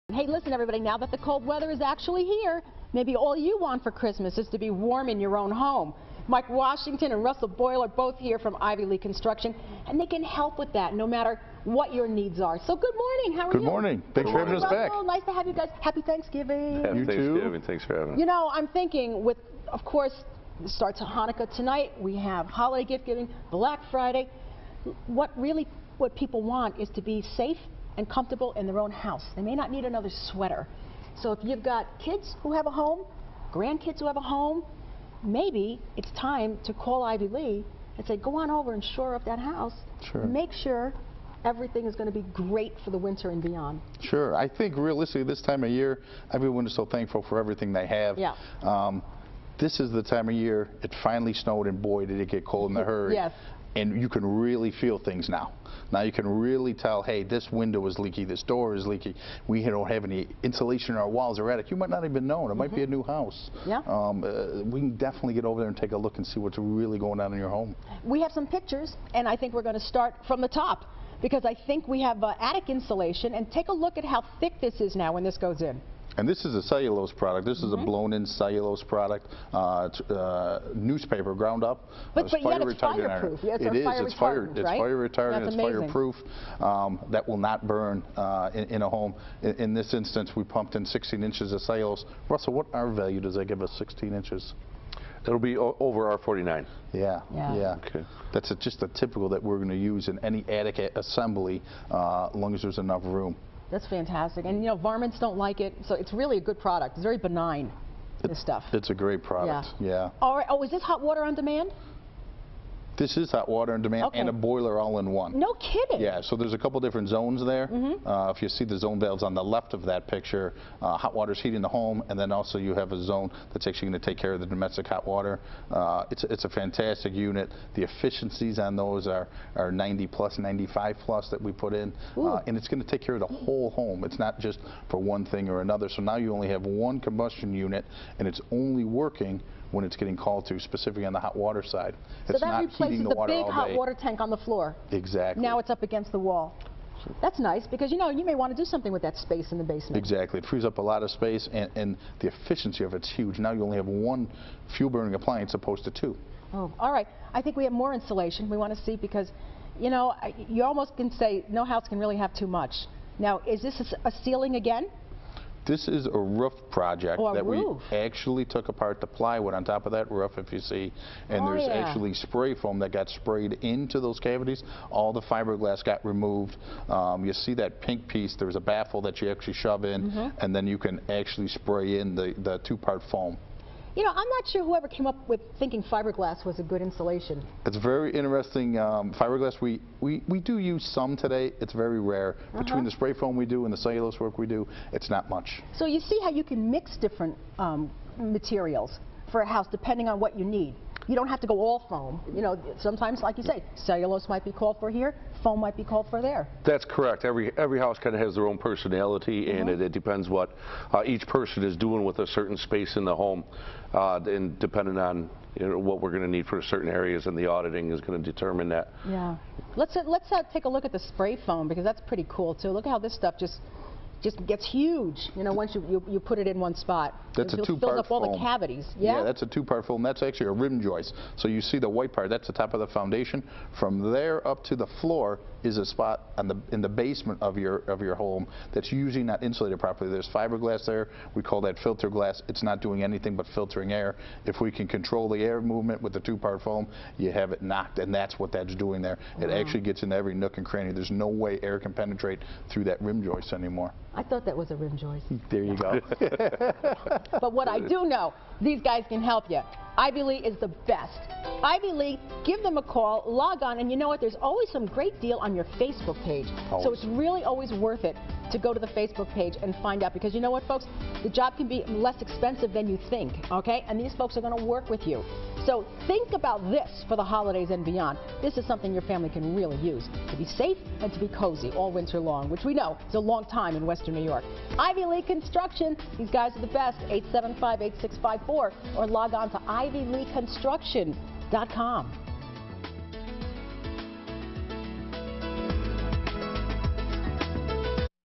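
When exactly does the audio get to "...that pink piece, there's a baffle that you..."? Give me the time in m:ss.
2:57.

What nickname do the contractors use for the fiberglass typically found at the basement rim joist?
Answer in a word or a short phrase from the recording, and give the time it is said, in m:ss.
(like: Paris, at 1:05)
filter glass, at 4:01.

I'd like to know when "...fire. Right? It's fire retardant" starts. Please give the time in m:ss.
1:24.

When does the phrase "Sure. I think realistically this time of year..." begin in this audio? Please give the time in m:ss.
0:44.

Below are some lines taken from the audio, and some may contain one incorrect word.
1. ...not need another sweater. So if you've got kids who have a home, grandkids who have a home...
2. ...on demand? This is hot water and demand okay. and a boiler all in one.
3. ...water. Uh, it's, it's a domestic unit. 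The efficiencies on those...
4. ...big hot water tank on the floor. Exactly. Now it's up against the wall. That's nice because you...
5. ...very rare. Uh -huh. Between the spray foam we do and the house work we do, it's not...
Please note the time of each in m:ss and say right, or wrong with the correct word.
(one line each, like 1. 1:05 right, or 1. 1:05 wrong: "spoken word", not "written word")
1. 0:29 right
2. 1:51 right
3. 2:05 wrong: "fantastic", not "domestic"
4. 2:23 right
5. 3:11 wrong: "cellulose", not "house".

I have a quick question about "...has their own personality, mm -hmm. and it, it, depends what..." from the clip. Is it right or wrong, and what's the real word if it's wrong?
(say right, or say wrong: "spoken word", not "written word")
right.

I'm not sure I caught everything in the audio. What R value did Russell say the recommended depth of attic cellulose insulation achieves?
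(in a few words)
over R49.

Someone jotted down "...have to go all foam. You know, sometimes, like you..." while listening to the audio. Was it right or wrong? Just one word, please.
right.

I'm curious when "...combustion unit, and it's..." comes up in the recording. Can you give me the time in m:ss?
2:16.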